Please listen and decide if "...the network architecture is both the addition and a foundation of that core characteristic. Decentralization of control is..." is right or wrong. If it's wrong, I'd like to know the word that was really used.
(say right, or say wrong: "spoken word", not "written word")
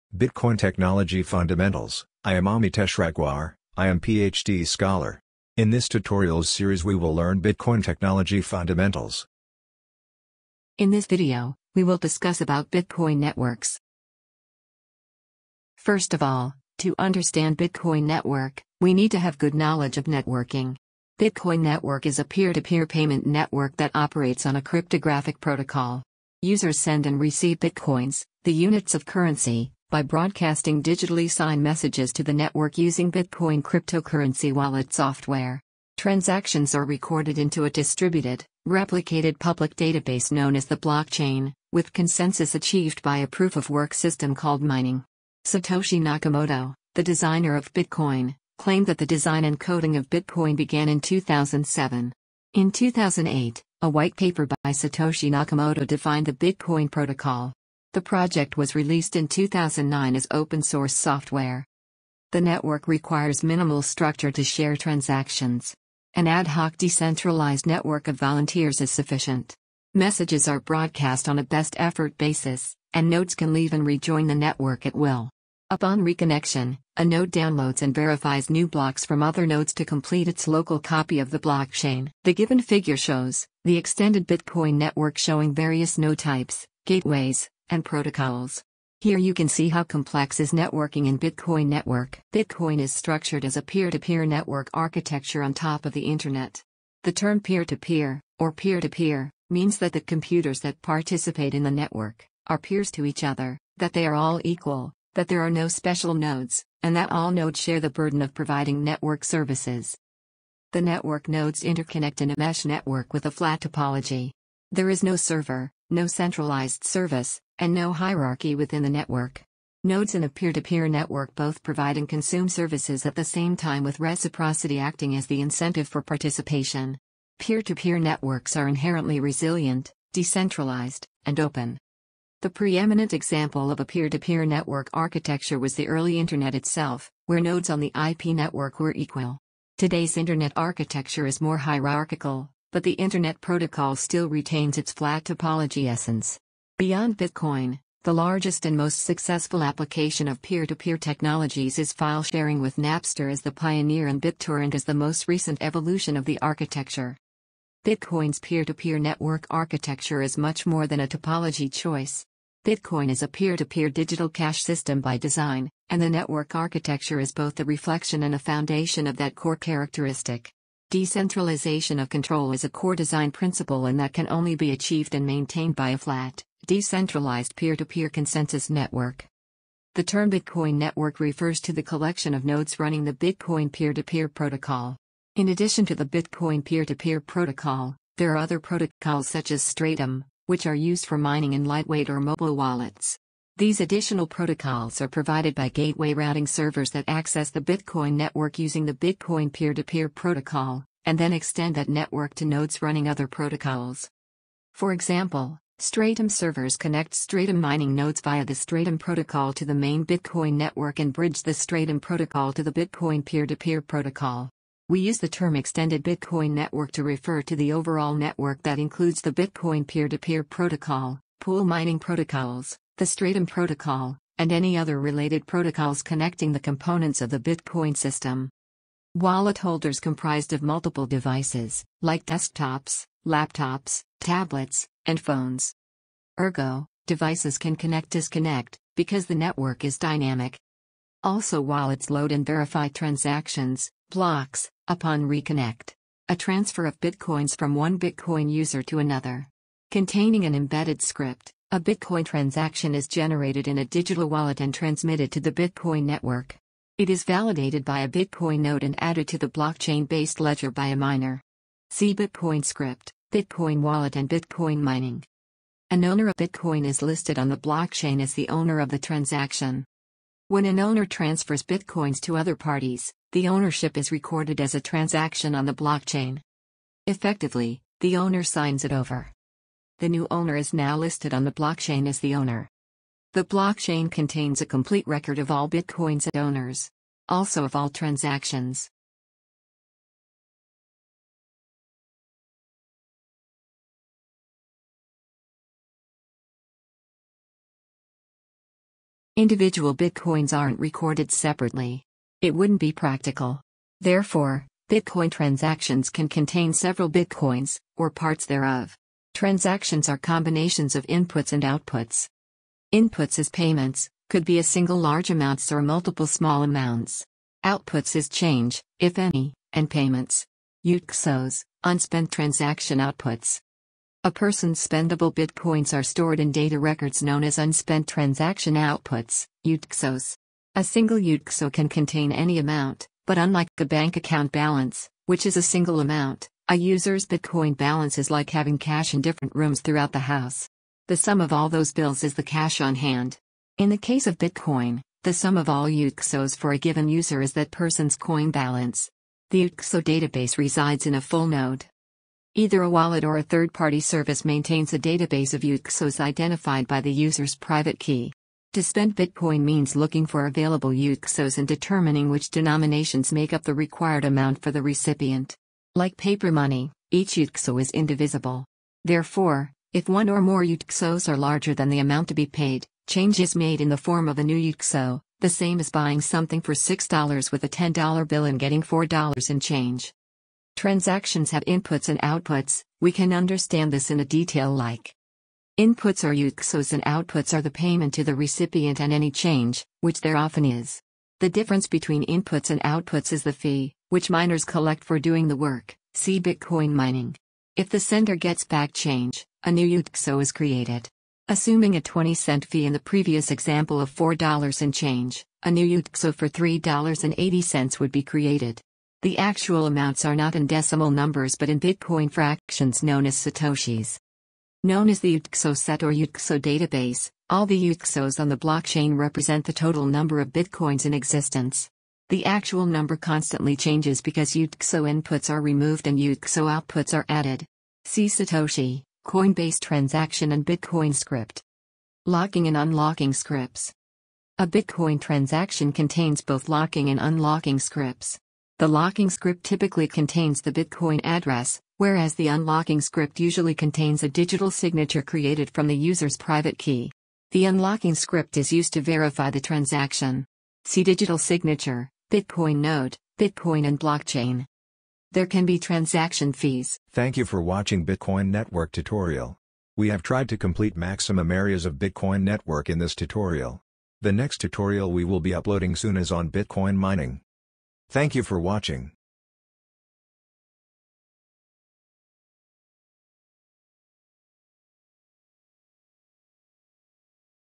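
wrong: "reflection", not "addition".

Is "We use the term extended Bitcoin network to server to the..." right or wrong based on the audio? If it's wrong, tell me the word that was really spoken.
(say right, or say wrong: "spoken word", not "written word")
wrong: "refer", not "server".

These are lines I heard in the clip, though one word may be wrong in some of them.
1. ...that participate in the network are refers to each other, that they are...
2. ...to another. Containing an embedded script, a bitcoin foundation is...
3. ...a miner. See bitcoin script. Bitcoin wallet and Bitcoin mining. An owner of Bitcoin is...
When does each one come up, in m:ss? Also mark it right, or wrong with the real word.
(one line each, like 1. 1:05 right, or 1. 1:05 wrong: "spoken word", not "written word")
1. 1:40 wrong: "peers", not "refers"
2. 4:08 wrong: "transaction", not "foundation"
3. 4:20 right.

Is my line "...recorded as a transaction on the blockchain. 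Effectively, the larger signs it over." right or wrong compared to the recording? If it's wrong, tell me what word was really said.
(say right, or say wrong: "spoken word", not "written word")
wrong: "owner", not "larger".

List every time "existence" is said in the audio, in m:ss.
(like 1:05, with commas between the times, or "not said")
7:01.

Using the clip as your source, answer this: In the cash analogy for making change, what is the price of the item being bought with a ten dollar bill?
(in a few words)
$6.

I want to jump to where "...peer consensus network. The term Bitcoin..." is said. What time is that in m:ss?
2:57.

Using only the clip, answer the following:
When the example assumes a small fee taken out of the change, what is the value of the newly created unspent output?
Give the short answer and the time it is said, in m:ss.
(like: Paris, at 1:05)
$3.80, at 6:46.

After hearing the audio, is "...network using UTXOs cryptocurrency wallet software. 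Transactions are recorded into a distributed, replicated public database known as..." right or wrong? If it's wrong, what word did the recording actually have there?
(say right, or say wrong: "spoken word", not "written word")
wrong: "Bitcoin", not "UTXOs".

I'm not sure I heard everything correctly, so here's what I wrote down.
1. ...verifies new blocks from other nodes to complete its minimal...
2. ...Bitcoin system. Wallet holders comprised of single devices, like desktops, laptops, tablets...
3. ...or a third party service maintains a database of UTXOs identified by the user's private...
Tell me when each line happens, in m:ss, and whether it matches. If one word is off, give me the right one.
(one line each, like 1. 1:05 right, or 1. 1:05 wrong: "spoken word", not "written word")
1. 1:17 wrong: "local", not "minimal"
2. 3:47 wrong: "multiple", not "single"
3. 5:53 right.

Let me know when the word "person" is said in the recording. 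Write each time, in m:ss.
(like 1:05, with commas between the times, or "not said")
5:24, 5:47.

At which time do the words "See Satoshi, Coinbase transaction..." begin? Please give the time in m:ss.
7:08.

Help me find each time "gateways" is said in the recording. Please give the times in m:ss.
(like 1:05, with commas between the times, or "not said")
1:26, 3:15.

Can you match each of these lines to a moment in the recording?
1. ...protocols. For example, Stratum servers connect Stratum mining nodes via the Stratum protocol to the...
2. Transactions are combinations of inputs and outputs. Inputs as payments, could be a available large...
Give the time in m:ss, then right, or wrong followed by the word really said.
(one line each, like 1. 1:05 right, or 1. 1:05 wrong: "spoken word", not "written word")
1. 3:23 right
2. 5:09 wrong: "single", not "available".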